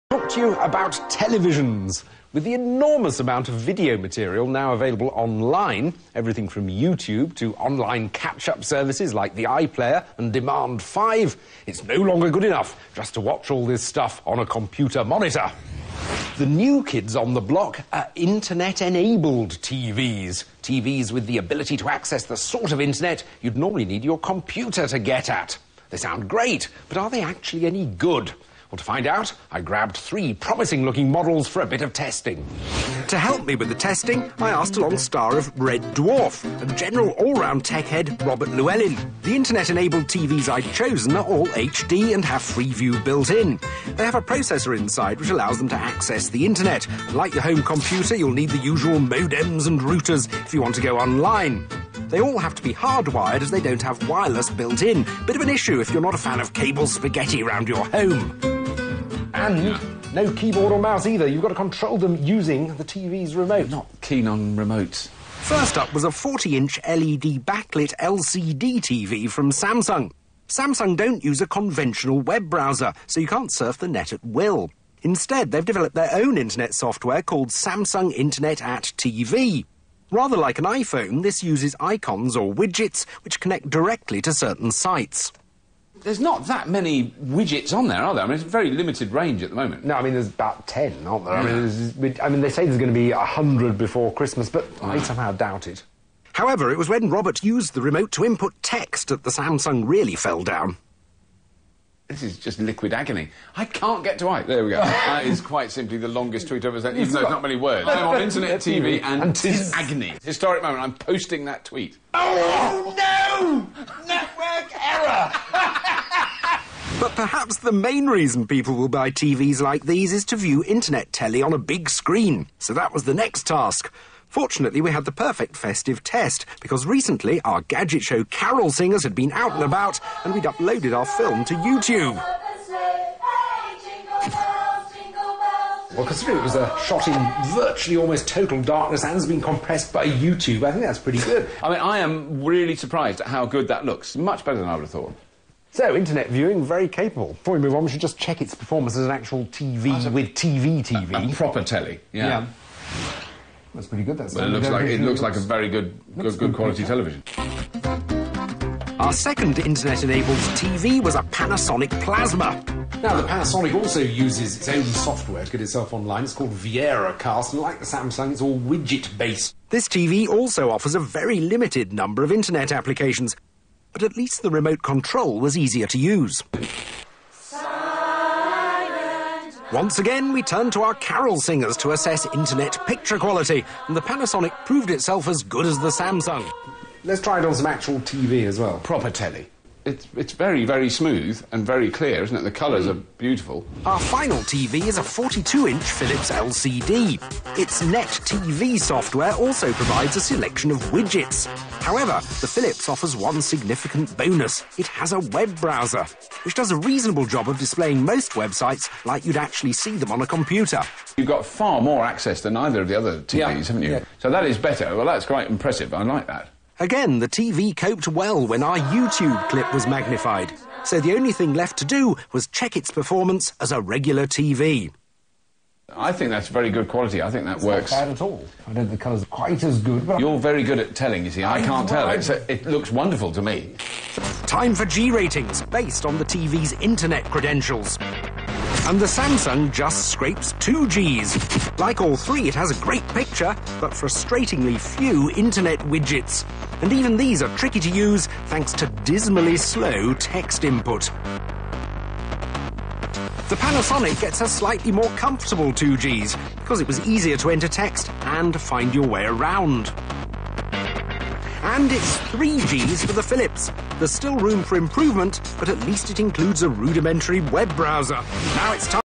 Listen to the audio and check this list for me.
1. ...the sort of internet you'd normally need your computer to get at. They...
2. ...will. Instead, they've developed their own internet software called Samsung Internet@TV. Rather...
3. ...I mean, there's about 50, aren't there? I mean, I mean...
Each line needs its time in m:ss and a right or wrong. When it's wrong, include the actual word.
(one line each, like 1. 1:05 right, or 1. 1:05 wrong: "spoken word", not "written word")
1. 0:22 right
2. 1:14 right
3. 1:29 wrong: "10", not "50".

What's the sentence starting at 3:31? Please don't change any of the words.
You've got far more access than either of the other TVs, yeah.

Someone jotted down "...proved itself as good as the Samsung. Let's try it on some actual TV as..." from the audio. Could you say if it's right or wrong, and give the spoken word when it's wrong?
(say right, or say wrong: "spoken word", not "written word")
right.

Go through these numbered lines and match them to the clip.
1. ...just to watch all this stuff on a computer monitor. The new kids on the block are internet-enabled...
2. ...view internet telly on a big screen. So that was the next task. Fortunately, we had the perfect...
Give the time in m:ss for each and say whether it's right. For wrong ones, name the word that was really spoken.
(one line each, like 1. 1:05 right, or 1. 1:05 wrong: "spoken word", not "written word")
1. 0:12 right
2. 2:00 right.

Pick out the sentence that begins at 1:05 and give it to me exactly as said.
First up was a 40-inch LED backlit LCD TV from Samsung.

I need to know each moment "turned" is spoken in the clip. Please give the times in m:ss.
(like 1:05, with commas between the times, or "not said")
3:00.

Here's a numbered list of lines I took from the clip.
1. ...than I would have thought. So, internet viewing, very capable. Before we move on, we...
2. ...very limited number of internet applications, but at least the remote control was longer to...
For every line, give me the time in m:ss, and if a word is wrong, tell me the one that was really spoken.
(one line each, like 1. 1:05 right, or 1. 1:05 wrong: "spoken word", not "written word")
1. 2:24 right
2. 2:50 wrong: "easier", not "longer".